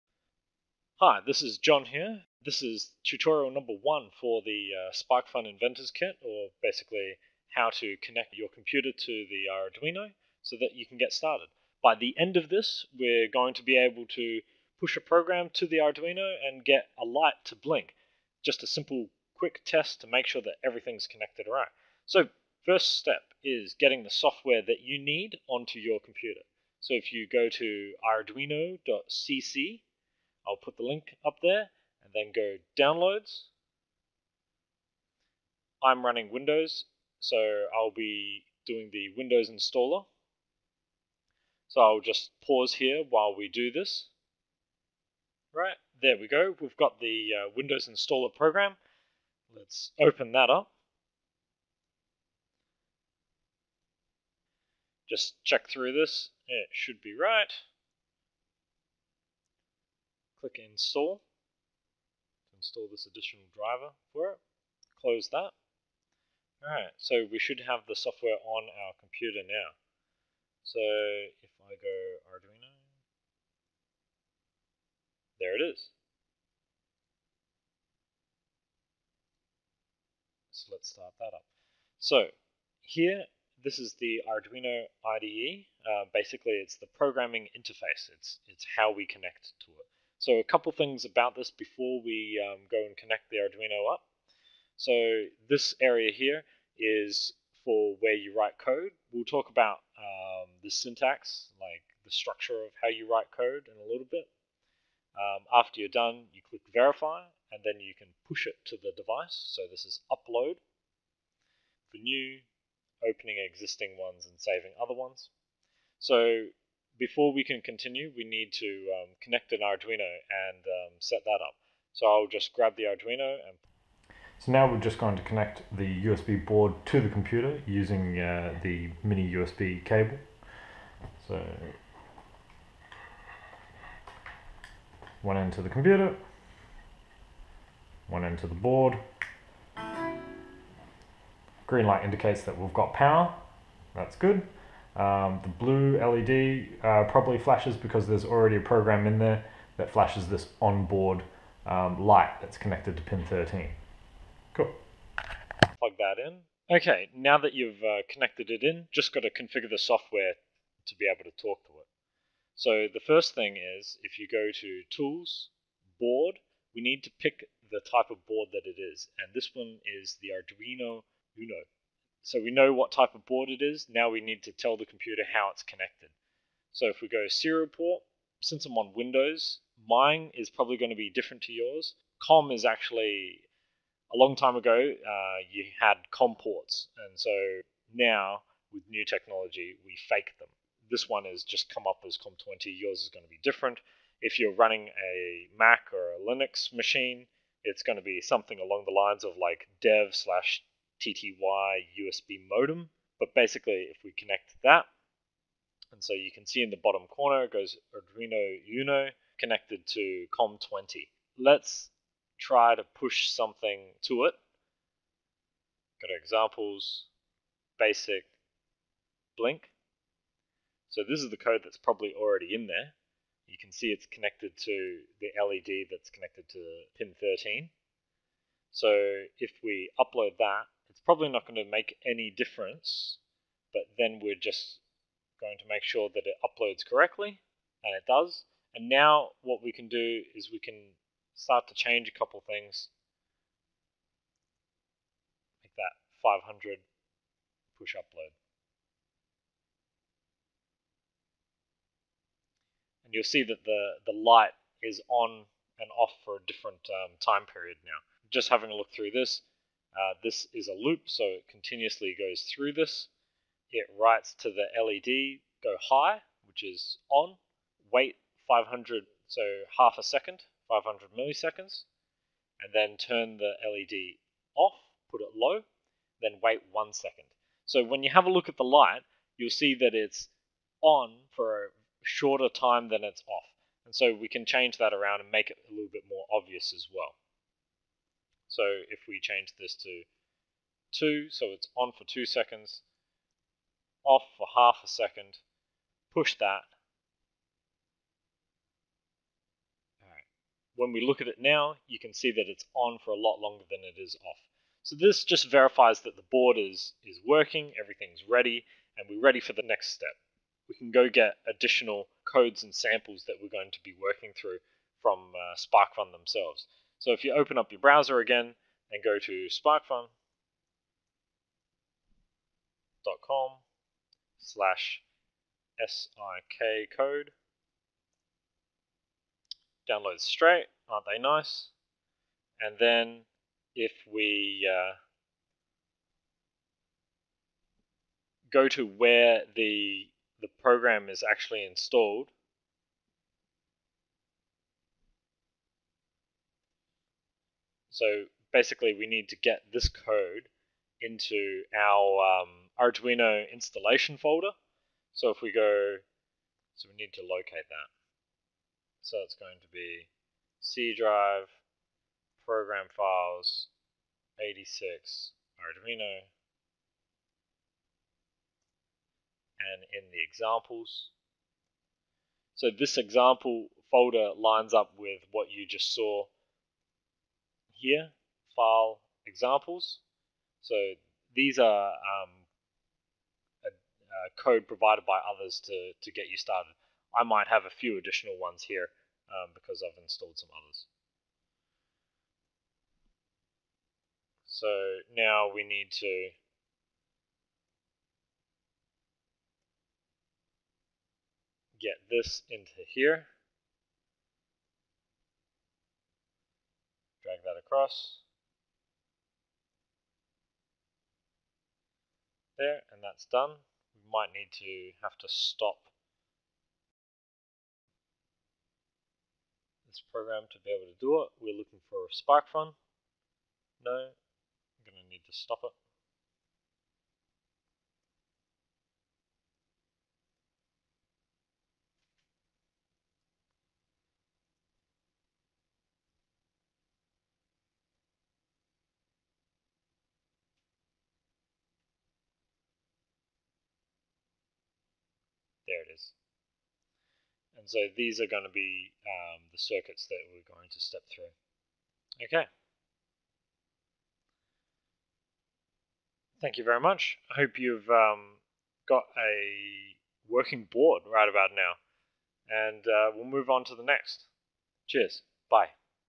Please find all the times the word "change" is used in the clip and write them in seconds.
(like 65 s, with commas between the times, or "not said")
241 s, 284 s, 289 s.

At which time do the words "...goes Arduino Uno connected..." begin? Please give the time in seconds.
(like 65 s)
207 s.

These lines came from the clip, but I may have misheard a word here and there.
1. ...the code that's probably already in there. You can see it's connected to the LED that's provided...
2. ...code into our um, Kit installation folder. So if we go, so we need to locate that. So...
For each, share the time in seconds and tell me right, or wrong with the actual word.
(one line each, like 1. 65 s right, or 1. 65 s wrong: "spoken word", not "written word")
1. 221 s wrong: "connected", not "provided"
2. 349 s wrong: "Arduino", not "Kit".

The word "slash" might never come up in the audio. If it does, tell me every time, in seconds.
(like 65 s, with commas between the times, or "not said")
200 s, 324 s.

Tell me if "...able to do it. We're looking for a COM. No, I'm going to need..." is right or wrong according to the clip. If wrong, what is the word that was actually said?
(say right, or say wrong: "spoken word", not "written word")
wrong: "SparkFun", not "COM".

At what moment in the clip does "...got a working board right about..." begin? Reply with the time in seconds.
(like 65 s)
458 s.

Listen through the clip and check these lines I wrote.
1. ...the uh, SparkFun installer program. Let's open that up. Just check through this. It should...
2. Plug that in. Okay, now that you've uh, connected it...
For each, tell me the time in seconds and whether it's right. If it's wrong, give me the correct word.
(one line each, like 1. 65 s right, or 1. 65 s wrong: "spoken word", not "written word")
1. 46 s wrong: "Windows", not "SparkFun"
2. 155 s right.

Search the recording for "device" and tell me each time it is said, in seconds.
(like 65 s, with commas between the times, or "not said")
108 s.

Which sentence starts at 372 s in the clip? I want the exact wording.
So this example folder lines up with what you just saw here, file examples.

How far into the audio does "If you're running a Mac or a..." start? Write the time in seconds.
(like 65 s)
194 s.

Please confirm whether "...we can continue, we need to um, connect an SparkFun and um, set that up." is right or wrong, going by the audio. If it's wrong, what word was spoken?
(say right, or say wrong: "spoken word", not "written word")
wrong: "Arduino", not "SparkFun".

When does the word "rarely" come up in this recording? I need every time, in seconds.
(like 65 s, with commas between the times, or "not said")
not said.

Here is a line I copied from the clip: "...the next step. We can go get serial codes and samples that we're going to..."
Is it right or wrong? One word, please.
wrong.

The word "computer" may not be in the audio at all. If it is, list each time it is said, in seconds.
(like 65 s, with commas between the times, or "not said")
8 s, 25 s, 68 s, 127 s, 135 s, 174 s.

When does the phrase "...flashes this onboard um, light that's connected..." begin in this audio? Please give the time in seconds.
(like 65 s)
149 s.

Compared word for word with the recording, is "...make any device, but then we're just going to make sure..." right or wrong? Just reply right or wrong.
wrong.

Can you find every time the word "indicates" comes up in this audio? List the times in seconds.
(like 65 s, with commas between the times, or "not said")
142 s.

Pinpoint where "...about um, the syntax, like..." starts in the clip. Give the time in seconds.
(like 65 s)
99 s.